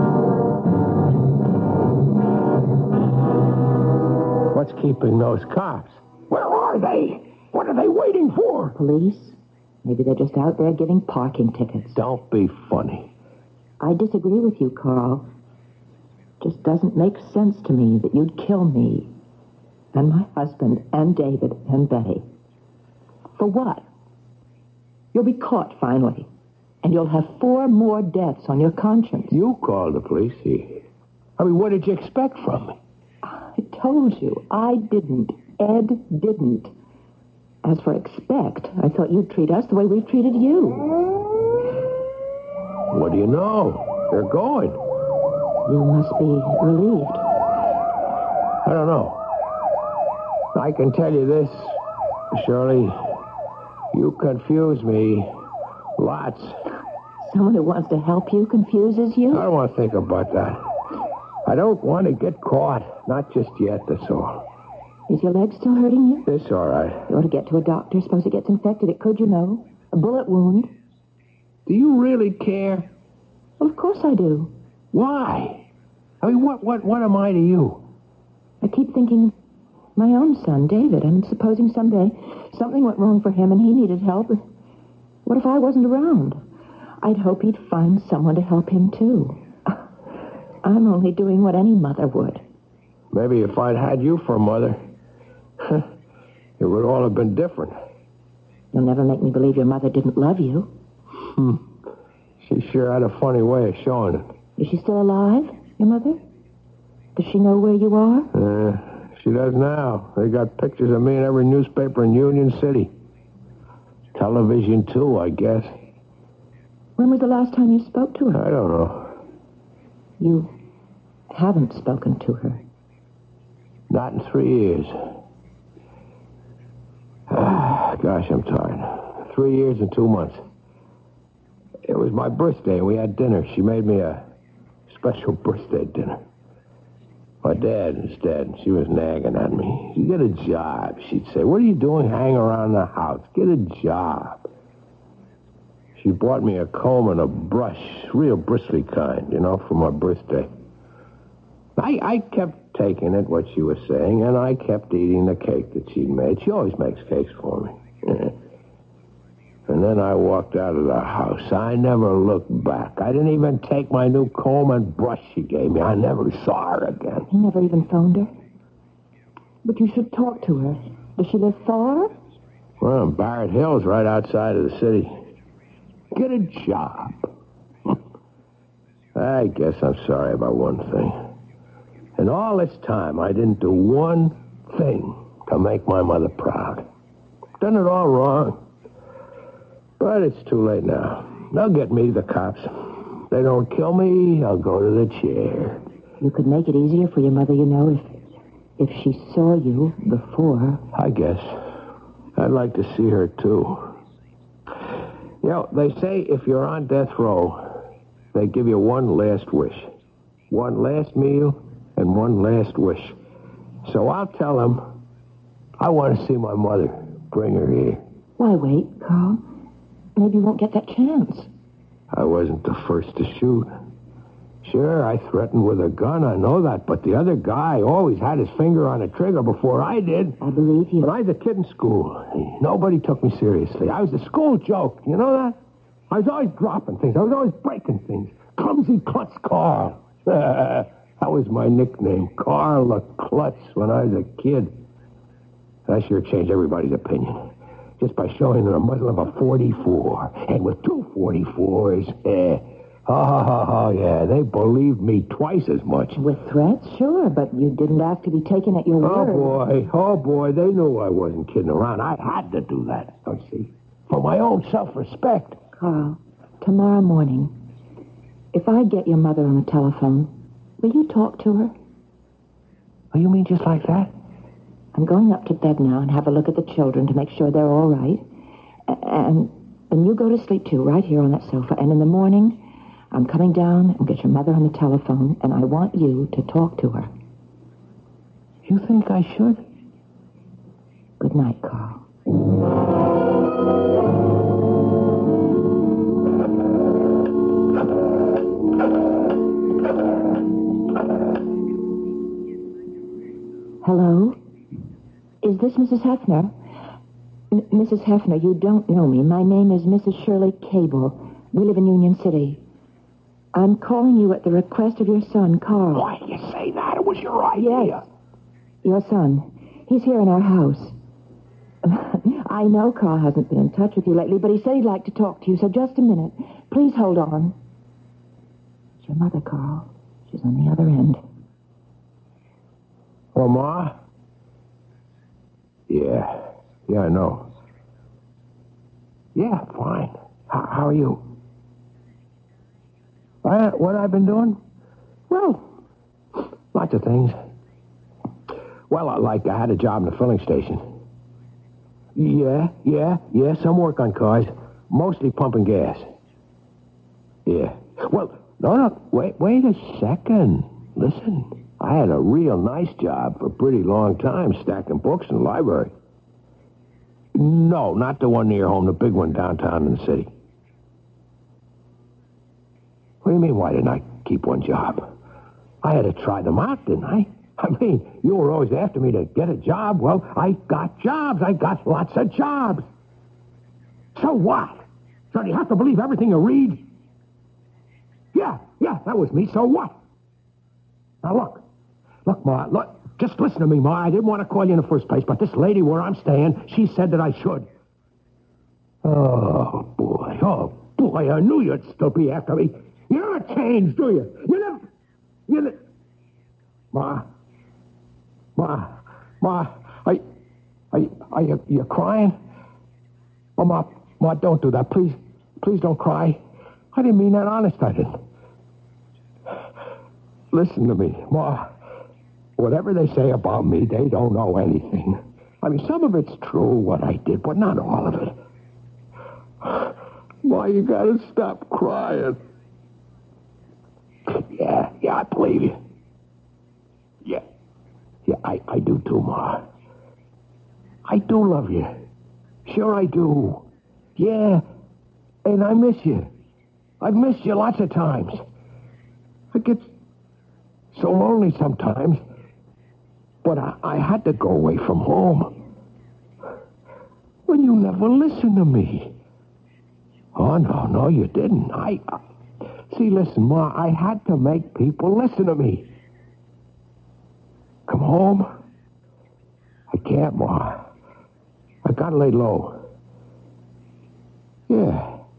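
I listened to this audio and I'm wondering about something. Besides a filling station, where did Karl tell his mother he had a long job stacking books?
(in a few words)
The library.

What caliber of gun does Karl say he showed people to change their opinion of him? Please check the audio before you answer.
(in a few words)
44.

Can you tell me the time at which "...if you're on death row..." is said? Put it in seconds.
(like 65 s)
206 s.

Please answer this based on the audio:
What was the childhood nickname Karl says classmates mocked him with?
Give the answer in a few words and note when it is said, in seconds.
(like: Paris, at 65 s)
Clumsy klutz Karl, at 238 s.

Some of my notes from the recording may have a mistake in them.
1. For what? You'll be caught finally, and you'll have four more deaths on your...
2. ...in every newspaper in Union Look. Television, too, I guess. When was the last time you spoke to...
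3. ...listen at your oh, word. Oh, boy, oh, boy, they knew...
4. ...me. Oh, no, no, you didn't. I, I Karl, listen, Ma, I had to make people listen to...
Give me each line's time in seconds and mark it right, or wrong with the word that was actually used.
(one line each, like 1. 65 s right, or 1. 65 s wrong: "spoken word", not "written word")
1. 23 s right
2. 111 s wrong: "City", not "Look"
3. 258 s wrong: "taken", not "listen"
4. 458 s wrong: "See", not "Karl".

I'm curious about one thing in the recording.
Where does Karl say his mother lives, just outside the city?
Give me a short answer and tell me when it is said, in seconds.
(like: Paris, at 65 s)
Barrett Hill, at 173 s.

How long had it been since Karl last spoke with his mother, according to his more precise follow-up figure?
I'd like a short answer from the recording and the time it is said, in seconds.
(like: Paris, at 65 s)
3 years and 2 months, at 129 s.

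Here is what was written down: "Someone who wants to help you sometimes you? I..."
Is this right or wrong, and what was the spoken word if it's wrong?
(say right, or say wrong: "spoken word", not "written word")
wrong: "confuses", not "sometimes".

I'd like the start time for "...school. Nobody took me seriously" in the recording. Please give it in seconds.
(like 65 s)
231 s.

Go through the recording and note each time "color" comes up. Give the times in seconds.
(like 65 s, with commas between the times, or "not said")
not said.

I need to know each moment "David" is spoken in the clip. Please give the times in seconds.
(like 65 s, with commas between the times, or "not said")
21 s, 80 s.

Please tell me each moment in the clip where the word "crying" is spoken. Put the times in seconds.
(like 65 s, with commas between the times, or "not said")
411 s, 431 s.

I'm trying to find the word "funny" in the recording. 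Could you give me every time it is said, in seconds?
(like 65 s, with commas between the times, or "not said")
12 s, 103 s.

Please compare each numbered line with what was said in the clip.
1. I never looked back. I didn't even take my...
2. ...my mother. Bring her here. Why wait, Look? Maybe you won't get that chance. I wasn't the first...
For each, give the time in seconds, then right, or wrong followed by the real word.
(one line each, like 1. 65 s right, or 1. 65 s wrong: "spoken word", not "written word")
1. 161 s right
2. 216 s wrong: "Karl", not "Look".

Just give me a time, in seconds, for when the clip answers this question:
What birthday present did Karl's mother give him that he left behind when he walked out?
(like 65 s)
146 s.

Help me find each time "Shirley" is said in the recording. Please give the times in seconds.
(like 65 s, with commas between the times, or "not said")
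52 s, 310 s.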